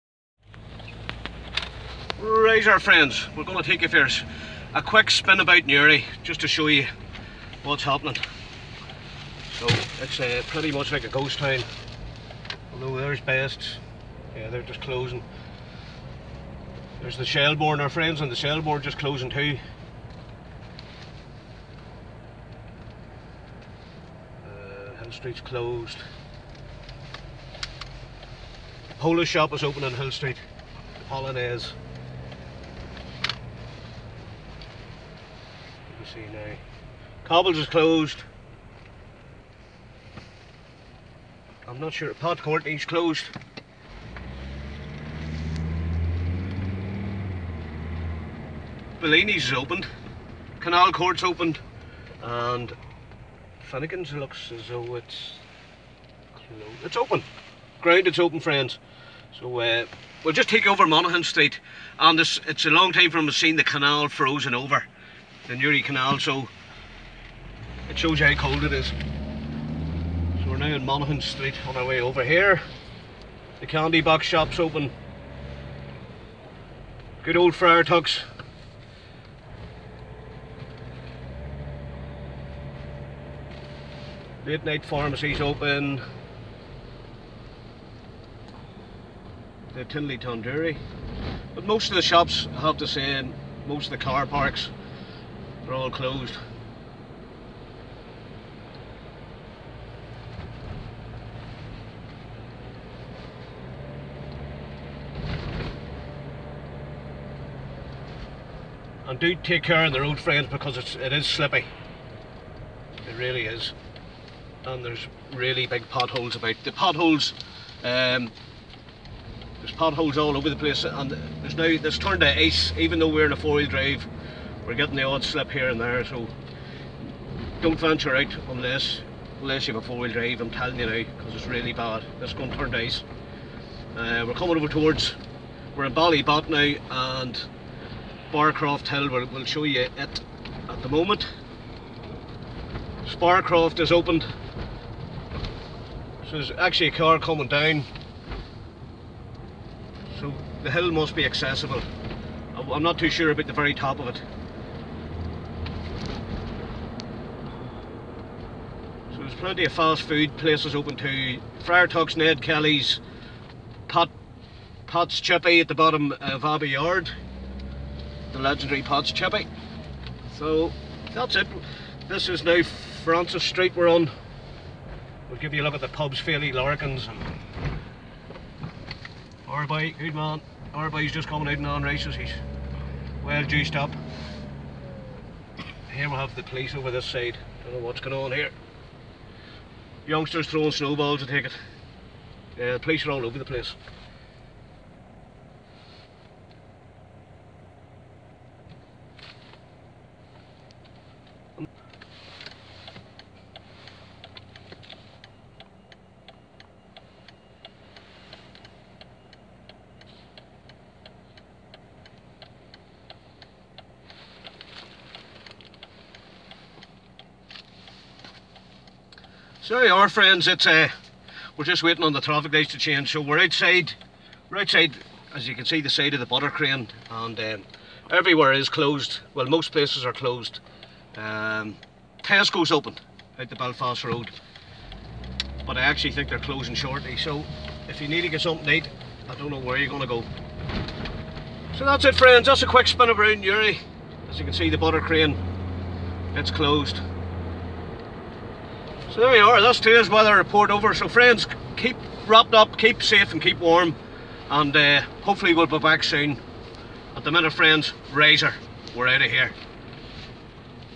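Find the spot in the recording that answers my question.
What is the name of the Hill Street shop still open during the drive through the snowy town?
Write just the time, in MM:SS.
00:30.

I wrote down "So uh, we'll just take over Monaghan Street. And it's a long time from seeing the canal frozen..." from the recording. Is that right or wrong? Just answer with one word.
right.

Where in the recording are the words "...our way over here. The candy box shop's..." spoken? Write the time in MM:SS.
01:11.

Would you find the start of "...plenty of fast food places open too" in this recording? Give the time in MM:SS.
02:39.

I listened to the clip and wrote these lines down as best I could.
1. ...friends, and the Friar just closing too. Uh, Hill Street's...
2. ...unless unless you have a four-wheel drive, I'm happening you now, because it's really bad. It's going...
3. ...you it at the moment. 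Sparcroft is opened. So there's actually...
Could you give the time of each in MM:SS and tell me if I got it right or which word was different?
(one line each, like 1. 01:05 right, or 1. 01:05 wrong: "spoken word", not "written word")
1. 00:17 wrong: "Shellbourne", not "Friar"
2. 02:08 wrong: "telling", not "happening"
3. 02:19 right.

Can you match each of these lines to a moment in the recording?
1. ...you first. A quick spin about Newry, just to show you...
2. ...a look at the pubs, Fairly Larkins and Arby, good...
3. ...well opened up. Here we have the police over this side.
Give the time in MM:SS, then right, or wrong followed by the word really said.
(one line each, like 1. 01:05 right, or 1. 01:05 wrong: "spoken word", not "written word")
1. 00:03 right
2. 02:55 right
3. 03:03 wrong: "juiced", not "opened".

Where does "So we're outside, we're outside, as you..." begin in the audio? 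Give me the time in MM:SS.
03:43.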